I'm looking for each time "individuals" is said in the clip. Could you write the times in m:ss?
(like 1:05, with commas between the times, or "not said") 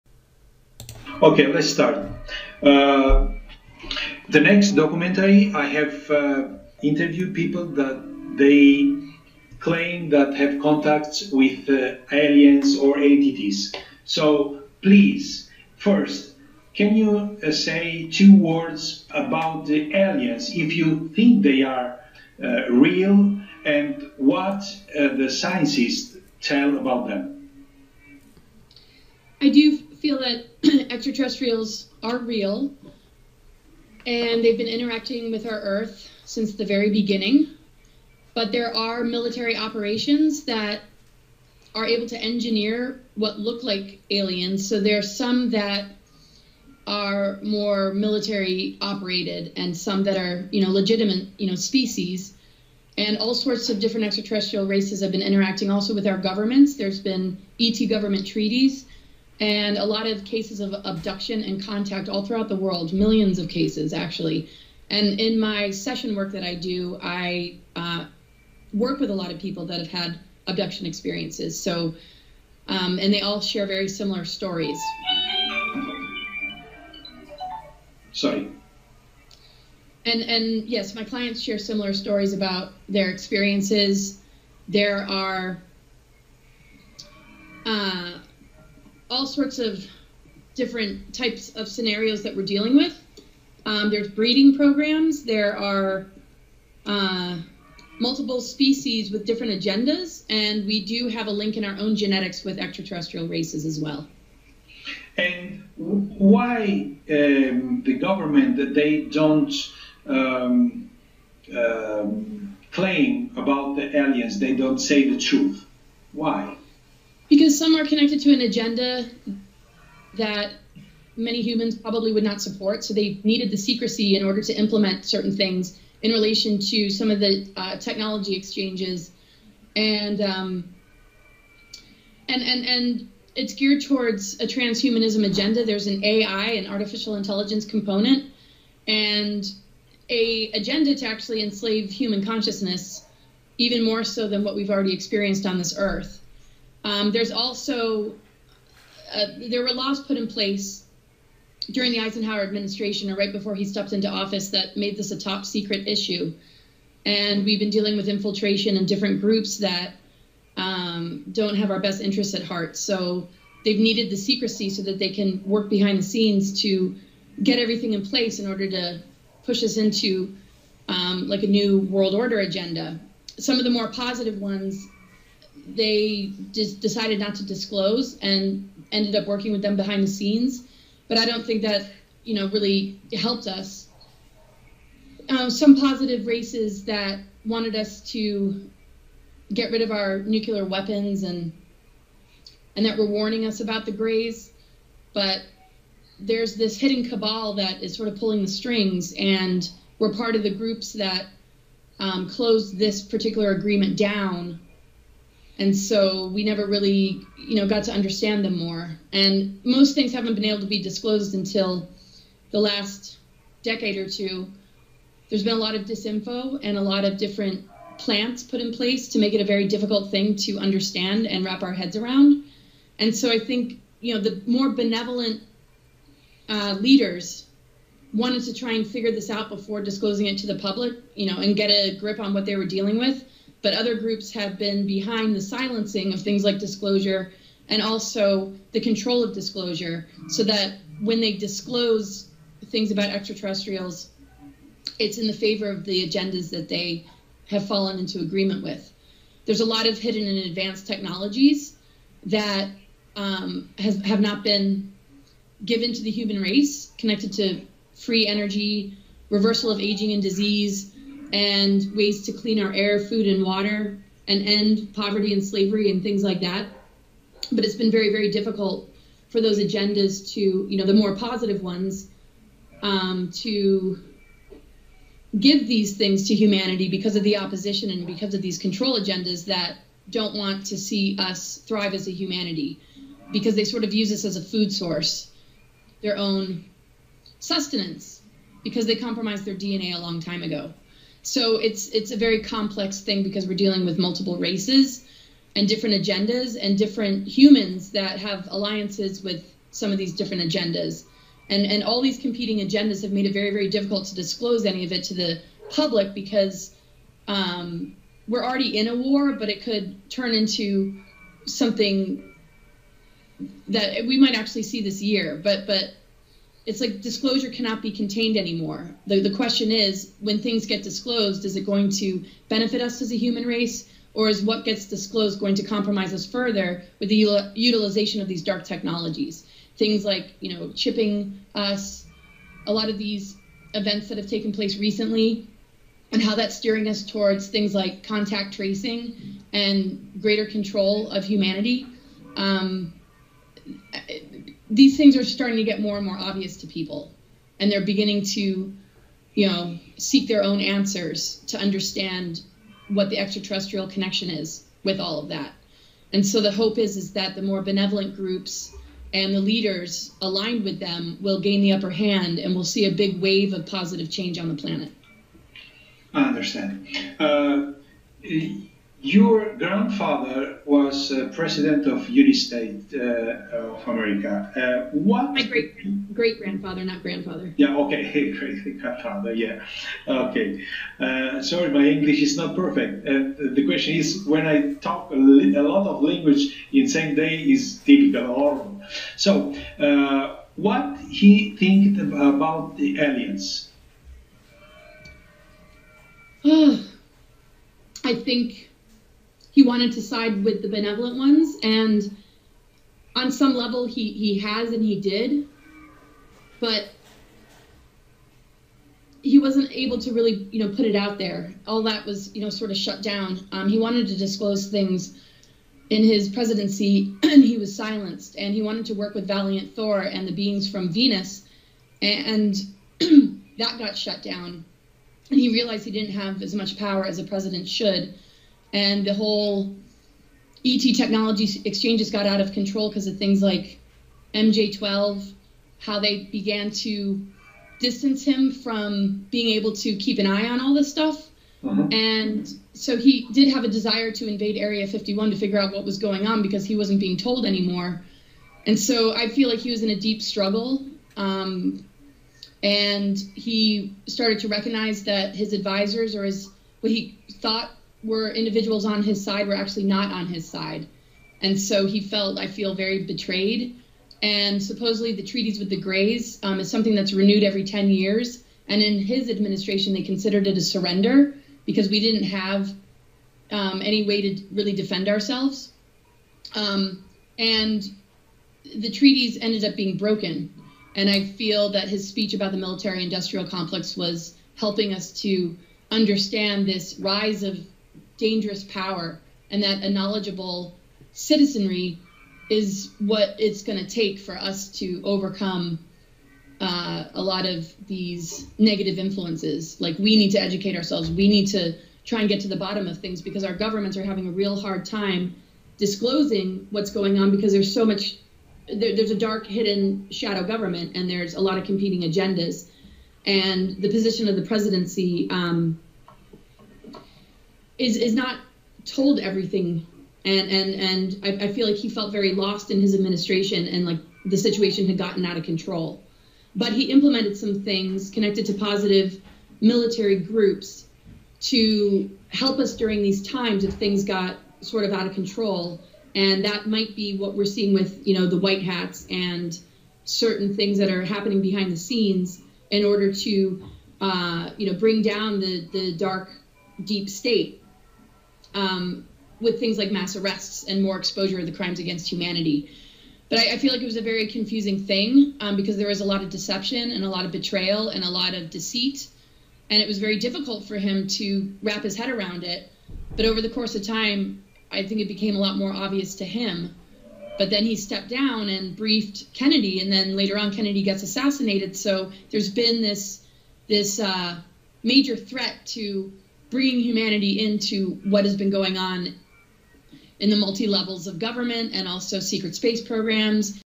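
7:38.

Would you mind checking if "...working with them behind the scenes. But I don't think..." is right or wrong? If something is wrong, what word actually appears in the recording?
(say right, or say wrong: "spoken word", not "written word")
right.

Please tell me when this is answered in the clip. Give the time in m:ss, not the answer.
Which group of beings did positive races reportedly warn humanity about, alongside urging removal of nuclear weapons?
3:13.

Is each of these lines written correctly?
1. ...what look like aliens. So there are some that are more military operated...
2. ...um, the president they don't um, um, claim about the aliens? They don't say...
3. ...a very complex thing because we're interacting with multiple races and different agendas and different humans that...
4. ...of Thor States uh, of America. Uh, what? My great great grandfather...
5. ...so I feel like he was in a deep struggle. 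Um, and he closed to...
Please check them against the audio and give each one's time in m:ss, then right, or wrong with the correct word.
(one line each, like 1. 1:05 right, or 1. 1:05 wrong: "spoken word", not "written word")
1. 0:43 right
2. 1:47 wrong: "government", not "president"
3. 4:52 wrong: "dealing", not "interacting"
4. 6:11 wrong: "United", not "Thor"
5. 7:28 wrong: "started", not "closed".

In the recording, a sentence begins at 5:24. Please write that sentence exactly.
Or is what gets disclosed going to compromise us further with the utilization of these dark technologies?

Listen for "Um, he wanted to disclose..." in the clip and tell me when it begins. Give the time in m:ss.
6:53.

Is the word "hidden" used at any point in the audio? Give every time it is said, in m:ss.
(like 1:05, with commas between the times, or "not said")
3:16, 4:09, 8:29.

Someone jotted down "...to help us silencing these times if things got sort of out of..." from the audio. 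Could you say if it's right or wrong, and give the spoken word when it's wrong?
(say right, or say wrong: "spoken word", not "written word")
wrong: "during", not "silencing".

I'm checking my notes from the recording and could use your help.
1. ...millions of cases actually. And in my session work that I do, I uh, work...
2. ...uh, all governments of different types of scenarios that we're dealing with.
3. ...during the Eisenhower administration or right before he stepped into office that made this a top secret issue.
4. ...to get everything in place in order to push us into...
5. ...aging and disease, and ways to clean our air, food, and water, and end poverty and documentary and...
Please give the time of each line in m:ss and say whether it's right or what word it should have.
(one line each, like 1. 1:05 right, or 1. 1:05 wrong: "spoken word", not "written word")
1. 1:02 right
2. 1:27 wrong: "sorts", not "governments"
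3. 2:31 right
4. 2:46 right
5. 4:19 wrong: "slavery", not "documentary".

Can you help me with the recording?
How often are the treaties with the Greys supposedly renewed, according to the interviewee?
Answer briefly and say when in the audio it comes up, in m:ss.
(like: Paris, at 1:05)
every 10 years, at 7:47.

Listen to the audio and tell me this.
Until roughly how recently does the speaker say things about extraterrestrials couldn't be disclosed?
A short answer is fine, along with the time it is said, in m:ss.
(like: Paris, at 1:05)
the last decade or two, at 3:32.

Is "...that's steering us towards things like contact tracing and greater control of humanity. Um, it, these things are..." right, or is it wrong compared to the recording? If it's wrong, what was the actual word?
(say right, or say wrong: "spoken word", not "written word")
right.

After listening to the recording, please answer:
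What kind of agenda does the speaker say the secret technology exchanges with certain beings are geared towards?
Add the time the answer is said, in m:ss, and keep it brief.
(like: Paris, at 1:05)
transhumanism, at 2:14.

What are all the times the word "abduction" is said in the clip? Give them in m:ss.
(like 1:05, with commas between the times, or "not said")
1:00, 1:10.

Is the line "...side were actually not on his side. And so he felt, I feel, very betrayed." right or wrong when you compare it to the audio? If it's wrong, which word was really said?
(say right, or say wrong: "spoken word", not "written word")
right.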